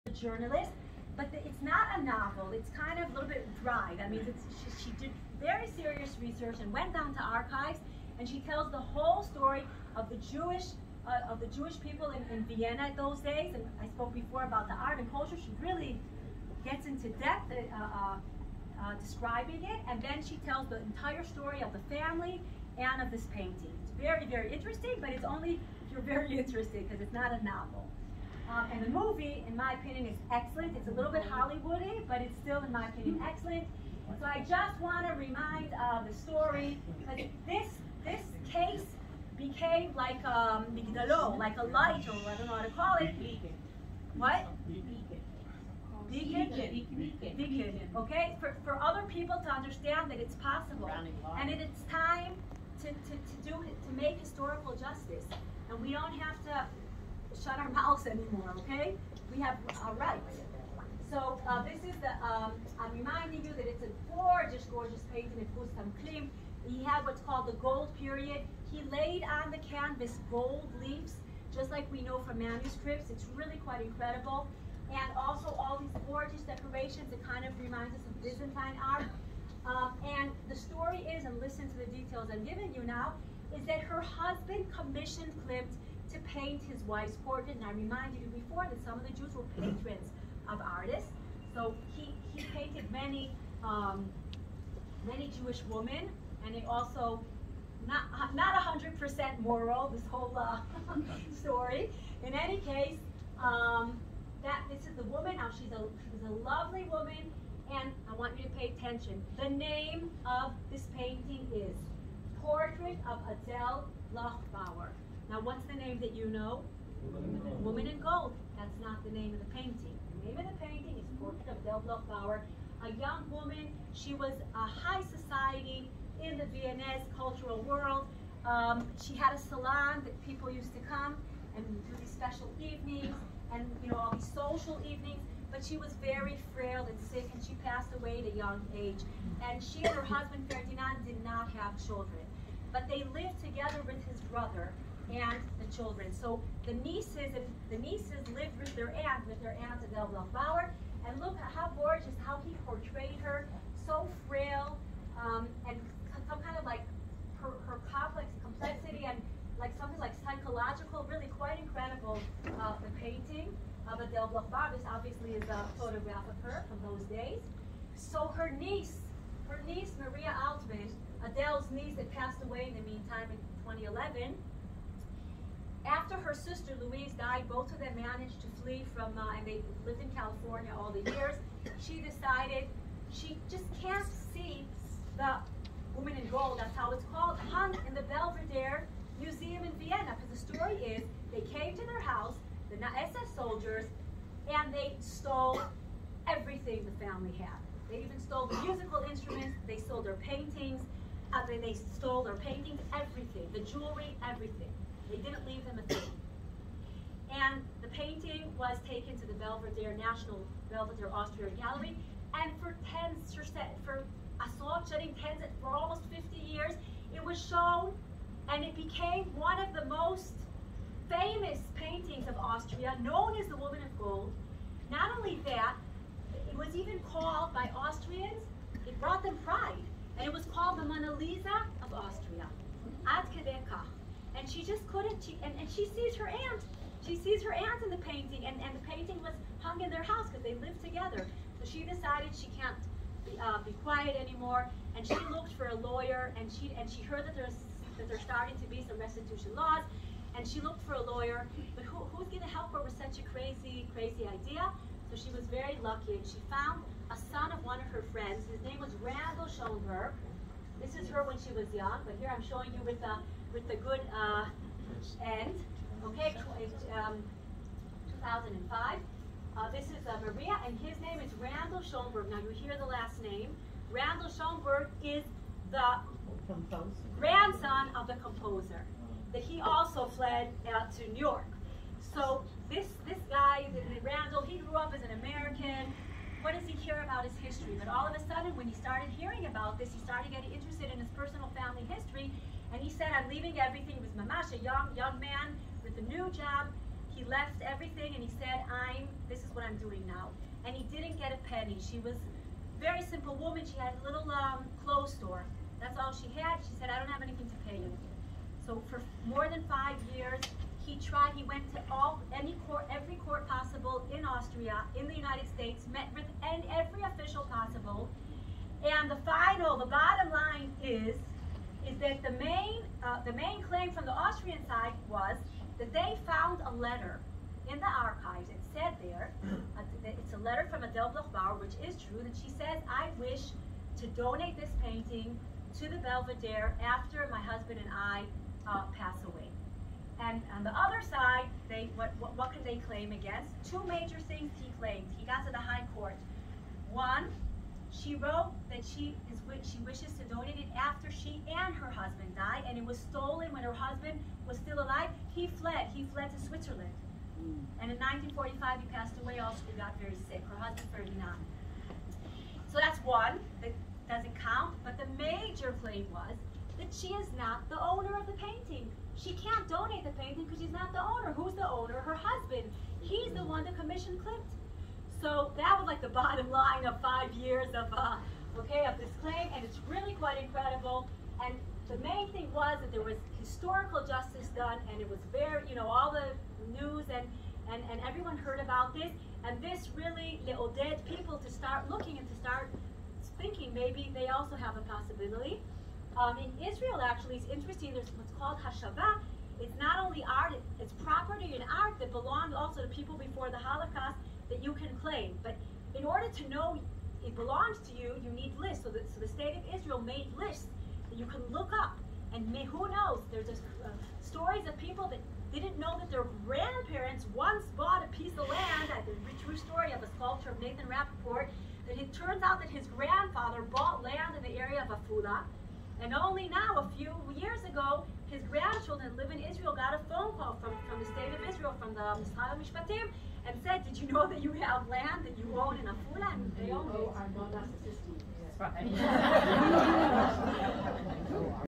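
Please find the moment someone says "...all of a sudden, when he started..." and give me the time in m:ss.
4:47.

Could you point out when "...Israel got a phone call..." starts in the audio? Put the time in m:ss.
7:09.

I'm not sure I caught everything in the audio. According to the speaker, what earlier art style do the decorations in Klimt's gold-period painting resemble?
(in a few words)
Byzantine art.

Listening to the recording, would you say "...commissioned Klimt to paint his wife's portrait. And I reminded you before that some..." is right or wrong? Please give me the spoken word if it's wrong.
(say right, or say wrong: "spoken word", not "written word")
right.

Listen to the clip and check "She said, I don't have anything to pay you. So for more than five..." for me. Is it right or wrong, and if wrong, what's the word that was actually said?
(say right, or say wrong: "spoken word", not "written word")
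right.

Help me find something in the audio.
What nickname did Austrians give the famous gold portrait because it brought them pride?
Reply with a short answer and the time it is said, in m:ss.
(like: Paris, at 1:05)
The Mona Lisa of Austria, at 3:50.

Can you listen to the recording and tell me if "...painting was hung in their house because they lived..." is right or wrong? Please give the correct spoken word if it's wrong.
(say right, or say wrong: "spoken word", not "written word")
right.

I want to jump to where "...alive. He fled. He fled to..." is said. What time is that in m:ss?
5:54.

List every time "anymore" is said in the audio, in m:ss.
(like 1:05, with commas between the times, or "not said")
0:58, 4:04.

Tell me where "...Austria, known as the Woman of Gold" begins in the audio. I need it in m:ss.
3:42.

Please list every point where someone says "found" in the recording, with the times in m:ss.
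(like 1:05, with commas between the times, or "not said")
4:16, 5:26.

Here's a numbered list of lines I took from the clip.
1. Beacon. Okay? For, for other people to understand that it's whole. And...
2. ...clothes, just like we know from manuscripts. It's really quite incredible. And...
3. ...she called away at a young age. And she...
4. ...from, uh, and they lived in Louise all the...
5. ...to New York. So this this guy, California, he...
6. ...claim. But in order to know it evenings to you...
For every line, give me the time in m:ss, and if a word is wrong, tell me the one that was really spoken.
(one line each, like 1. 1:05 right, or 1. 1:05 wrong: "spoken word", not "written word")
1. 0:47 wrong: "possible", not "whole"
2. 1:10 wrong: "leaves", not "clothes"
3. 2:17 wrong: "passed", not "called"
4. 2:58 wrong: "California", not "Louise"
5. 4:40 wrong: "Randol", not "California"
6. 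6:45 wrong: "belongs", not "evenings".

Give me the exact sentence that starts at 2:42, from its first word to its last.
Uh, the painting of Adele Bloch-Bauer.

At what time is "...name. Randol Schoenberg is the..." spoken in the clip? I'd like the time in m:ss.
4:33.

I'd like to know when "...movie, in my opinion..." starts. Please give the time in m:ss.
0:28.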